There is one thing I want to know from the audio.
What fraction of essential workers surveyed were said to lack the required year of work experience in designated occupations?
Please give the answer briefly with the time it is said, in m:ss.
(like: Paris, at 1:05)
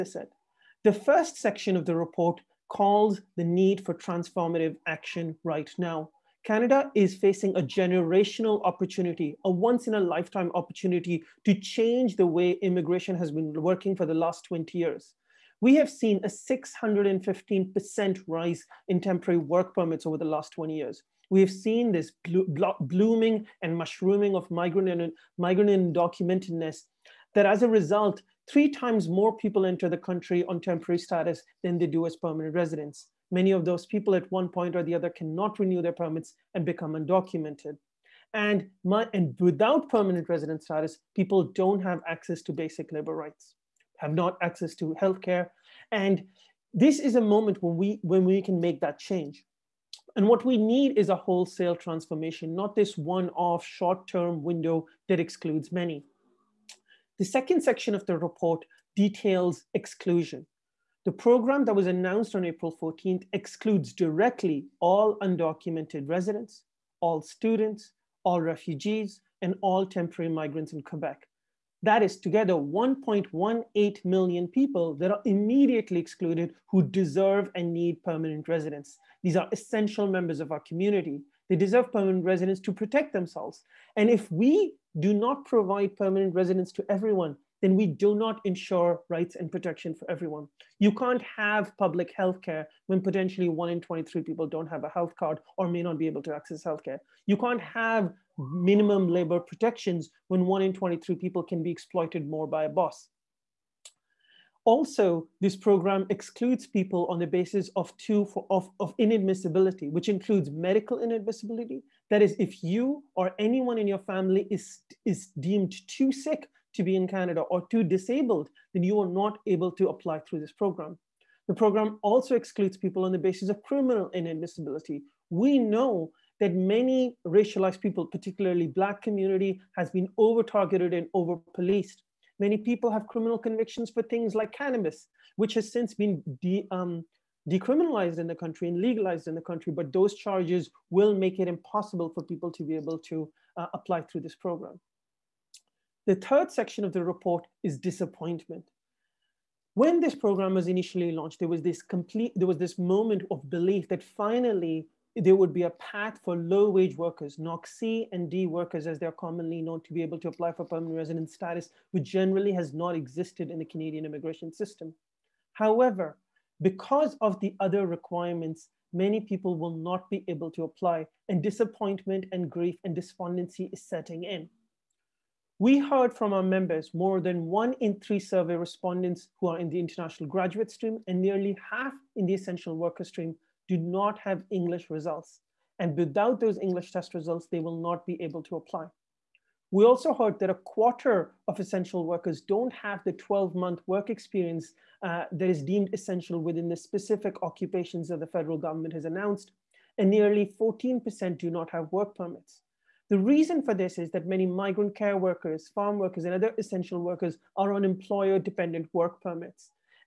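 a quarter, at 3:10.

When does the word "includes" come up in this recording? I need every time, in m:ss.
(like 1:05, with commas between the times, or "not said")
1:50.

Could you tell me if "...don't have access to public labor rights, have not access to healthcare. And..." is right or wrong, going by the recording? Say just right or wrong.
wrong.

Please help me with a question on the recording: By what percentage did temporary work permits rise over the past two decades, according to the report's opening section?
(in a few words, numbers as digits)
615%.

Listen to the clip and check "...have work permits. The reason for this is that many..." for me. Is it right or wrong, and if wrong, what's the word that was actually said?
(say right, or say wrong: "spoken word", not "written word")
right.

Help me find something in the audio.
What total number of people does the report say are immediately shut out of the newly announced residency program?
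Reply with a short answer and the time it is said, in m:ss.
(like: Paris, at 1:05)
1.18 million, at 1:12.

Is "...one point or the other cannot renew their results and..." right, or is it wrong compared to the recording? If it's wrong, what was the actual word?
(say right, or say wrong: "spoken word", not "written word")
wrong: "permits", not "results".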